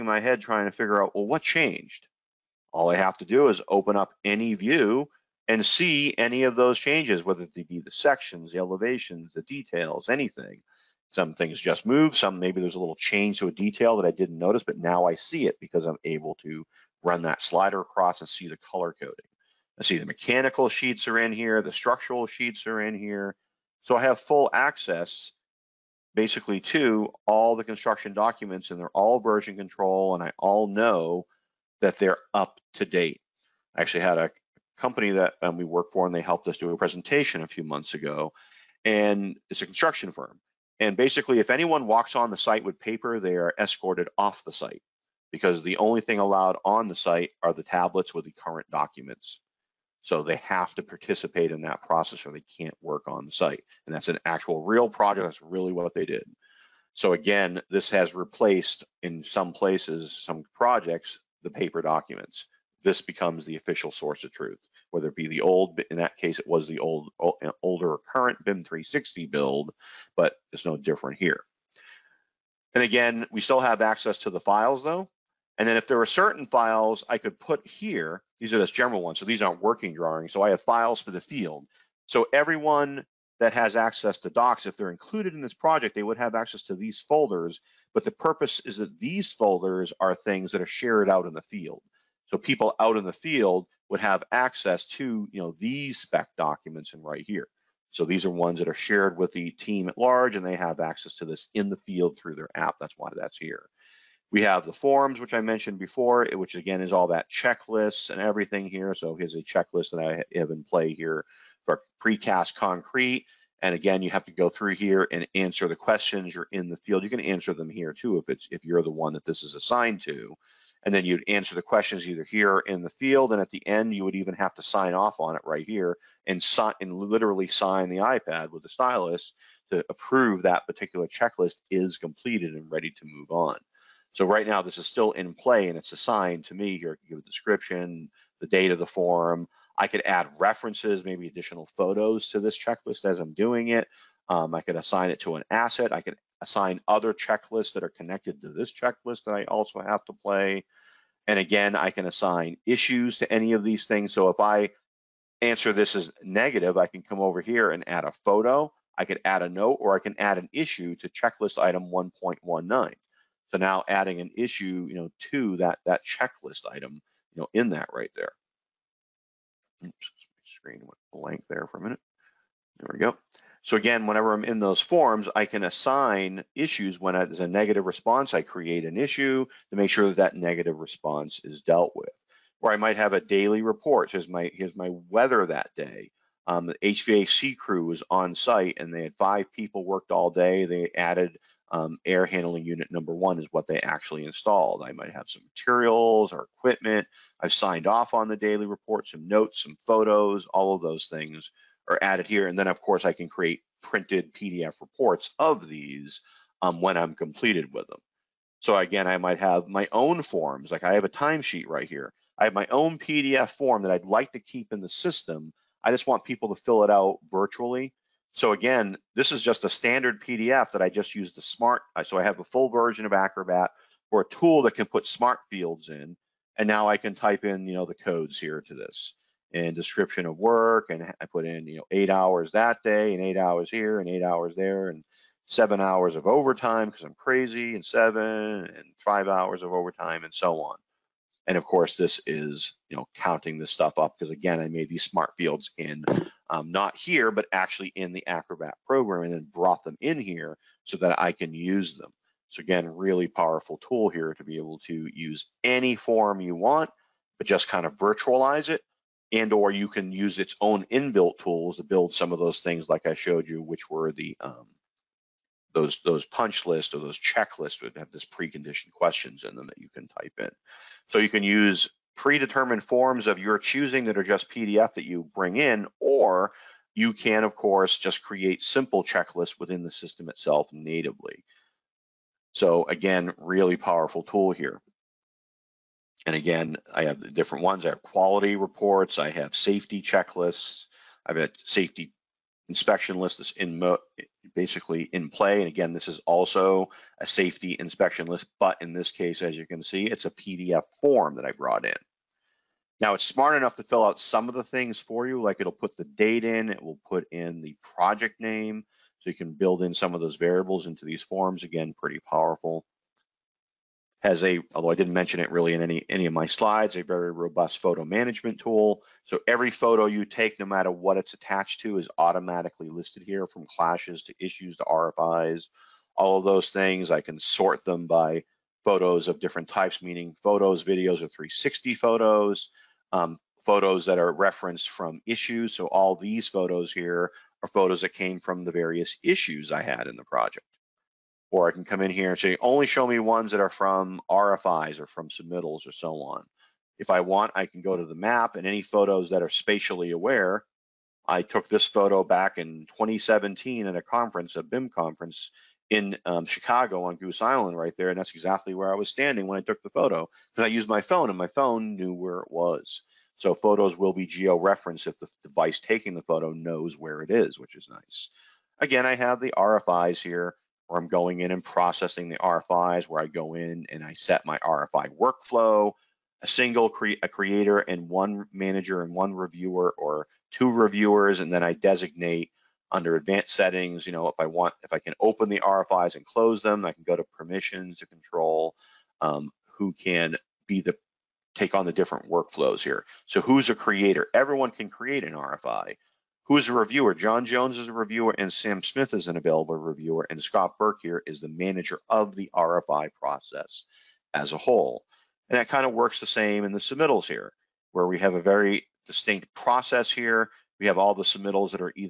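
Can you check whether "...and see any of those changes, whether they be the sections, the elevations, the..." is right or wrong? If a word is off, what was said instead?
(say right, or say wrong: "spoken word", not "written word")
right.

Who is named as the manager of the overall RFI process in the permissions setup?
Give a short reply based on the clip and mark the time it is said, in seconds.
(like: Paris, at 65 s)
Scott Burke, at 400 s.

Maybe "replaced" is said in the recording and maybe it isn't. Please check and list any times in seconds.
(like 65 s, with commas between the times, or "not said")
58 s.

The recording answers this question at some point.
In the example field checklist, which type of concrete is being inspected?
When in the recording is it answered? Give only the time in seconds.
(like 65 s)
112 s.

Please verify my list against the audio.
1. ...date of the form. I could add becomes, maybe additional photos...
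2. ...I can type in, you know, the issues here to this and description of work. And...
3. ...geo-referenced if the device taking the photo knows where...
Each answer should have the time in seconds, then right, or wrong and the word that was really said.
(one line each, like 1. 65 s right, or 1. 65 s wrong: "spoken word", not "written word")
1. 138 s wrong: "references", not "becomes"
2. 226 s wrong: "codes", not "issues"
3. 364 s right.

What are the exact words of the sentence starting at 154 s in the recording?
So if I answer this as negative, I can come over here and add a photo.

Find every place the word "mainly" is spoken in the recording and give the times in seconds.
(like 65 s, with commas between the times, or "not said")
not said.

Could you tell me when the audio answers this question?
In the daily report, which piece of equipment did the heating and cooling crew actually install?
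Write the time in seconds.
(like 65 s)
192 s.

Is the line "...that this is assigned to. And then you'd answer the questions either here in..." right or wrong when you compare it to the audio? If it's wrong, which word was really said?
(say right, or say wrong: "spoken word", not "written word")
right.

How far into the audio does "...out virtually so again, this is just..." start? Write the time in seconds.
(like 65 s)
216 s.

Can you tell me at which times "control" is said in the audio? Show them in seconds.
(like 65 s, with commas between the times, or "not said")
29 s, 388 s.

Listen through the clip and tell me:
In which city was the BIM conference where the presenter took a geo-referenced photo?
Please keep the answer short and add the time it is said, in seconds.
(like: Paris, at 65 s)
Chicago, at 356 s.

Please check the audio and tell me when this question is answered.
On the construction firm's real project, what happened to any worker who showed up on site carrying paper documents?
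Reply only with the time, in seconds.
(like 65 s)
43 s.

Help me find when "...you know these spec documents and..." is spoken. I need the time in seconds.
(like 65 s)
95 s.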